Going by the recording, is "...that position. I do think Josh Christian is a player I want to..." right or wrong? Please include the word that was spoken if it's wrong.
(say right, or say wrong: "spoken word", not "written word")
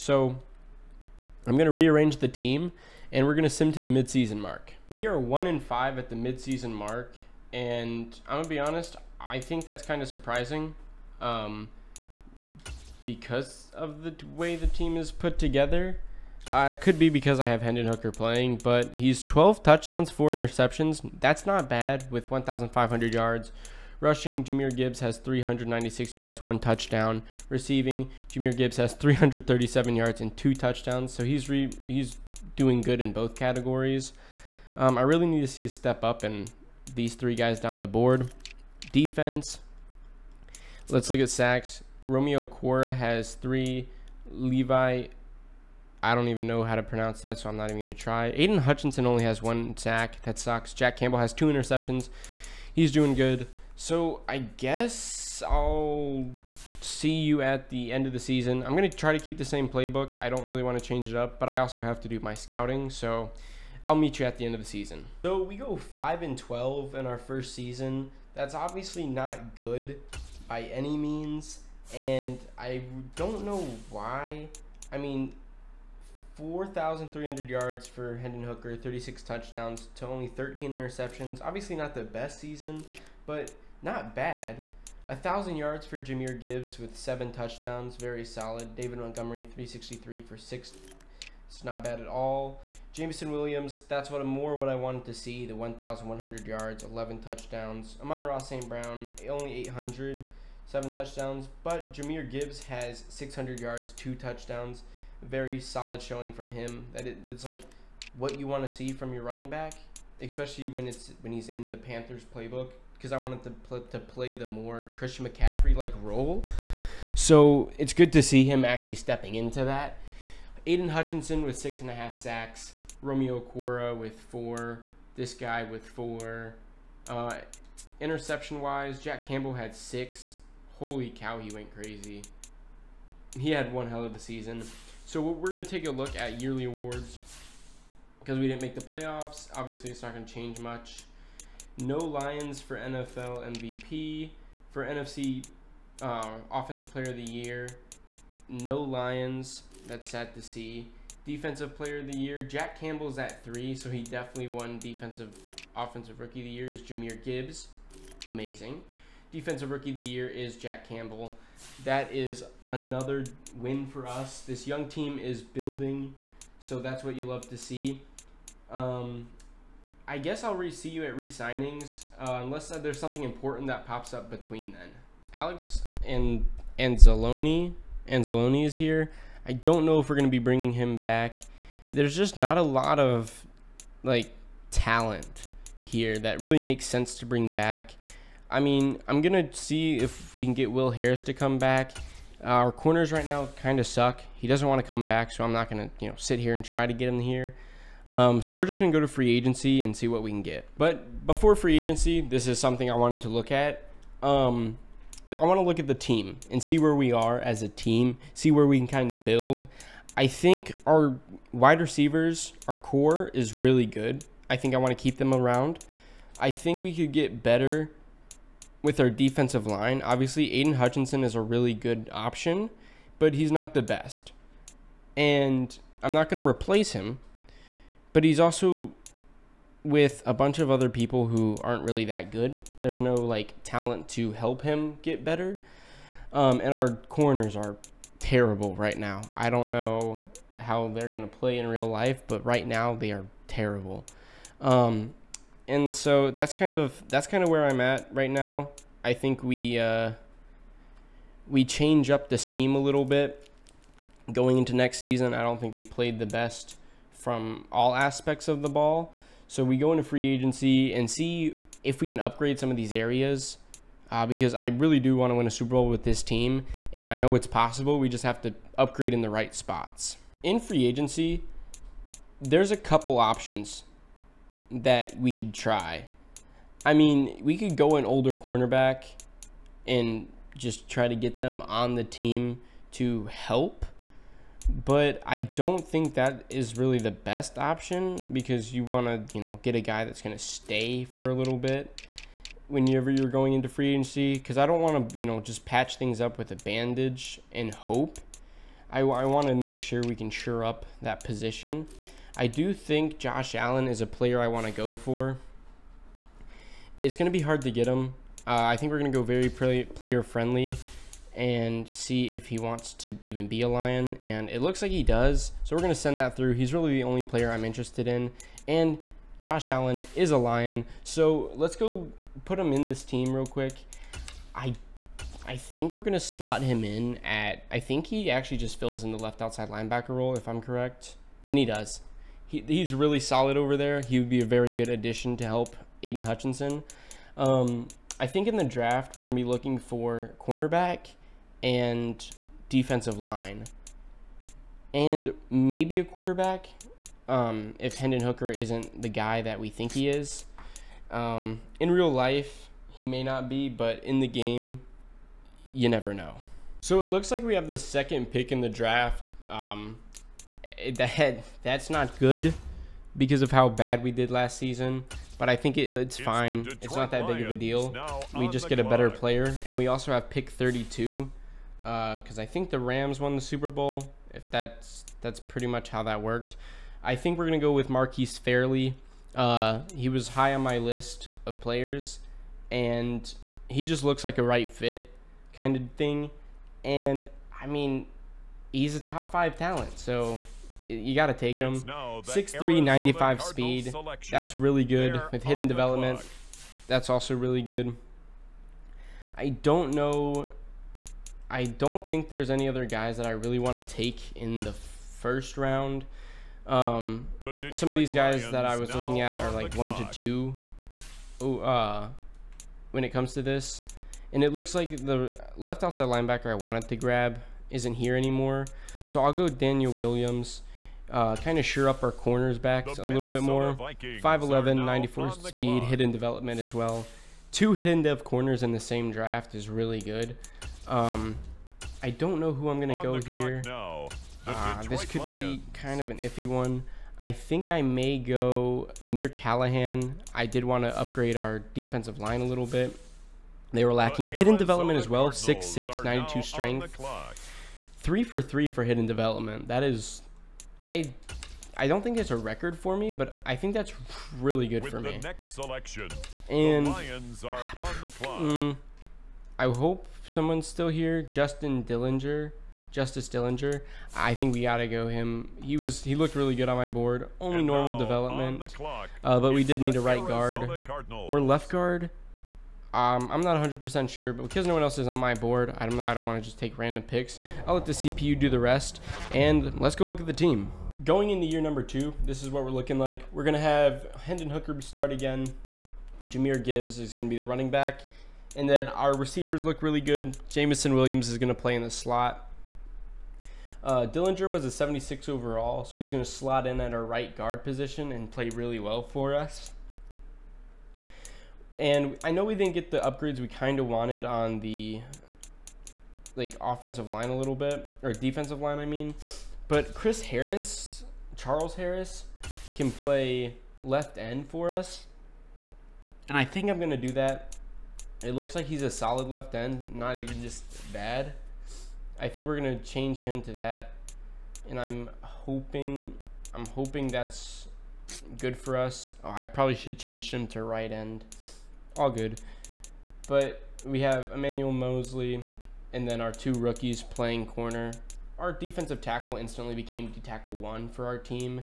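wrong: "Allen", not "Christian".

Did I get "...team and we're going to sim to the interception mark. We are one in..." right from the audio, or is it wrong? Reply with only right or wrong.
wrong.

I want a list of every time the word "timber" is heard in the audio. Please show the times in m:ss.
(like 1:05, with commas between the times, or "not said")
not said.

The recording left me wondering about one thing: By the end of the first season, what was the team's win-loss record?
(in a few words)
5 and 12.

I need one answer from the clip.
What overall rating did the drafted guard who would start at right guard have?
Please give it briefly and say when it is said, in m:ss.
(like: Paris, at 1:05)
76, at 8:14.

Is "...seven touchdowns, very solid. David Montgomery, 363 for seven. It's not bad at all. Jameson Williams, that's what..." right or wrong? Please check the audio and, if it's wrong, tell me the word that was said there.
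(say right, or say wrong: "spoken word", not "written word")
wrong: "six", not "seven".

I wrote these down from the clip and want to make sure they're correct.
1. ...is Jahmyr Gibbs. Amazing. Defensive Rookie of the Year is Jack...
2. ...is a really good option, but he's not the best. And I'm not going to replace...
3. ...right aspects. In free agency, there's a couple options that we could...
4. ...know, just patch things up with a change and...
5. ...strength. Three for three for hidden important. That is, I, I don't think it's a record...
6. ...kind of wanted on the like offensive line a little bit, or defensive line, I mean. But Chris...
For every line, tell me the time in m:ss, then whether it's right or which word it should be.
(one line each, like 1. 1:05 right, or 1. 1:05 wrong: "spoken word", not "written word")
1. 2:36 right
2. 3:41 right
3. 4:29 wrong: "spots", not "aspects"
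4. 4:55 wrong: "bandage", not "change"
5. 7:26 wrong: "development", not "important"
6. 8:23 right.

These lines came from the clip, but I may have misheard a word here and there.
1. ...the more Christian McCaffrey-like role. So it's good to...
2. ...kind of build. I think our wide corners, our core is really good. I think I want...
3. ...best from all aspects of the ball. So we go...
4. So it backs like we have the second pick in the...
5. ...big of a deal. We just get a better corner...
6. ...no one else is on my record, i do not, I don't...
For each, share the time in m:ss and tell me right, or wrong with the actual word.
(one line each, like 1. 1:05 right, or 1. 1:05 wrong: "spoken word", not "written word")
1. 1:54 right
2. 3:28 wrong: "receivers", not "corners"
3. 4:16 right
4. 5:56 wrong: "looks", not "backs"
5. 6:07 wrong: "player", not "corner"
6. 7:54 wrong: "board", not "record".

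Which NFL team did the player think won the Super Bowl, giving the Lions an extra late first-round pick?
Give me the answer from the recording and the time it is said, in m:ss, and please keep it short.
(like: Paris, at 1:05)
Rams, at 6:12.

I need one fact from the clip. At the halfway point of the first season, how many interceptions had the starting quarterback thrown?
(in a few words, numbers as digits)
4.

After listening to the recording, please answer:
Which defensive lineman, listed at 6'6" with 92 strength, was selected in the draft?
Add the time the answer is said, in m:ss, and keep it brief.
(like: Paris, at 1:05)
Amir Callahan, at 7:18.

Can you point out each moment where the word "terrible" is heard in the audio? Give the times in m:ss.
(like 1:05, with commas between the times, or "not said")
3:58, 4:03.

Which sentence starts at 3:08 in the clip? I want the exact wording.
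I mean, I'm going to see if we can get Will Harris to come back.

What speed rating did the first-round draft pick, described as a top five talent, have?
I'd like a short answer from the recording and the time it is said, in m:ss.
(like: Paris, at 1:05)
95, at 6:32.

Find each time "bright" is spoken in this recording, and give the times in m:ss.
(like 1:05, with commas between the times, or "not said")
not said.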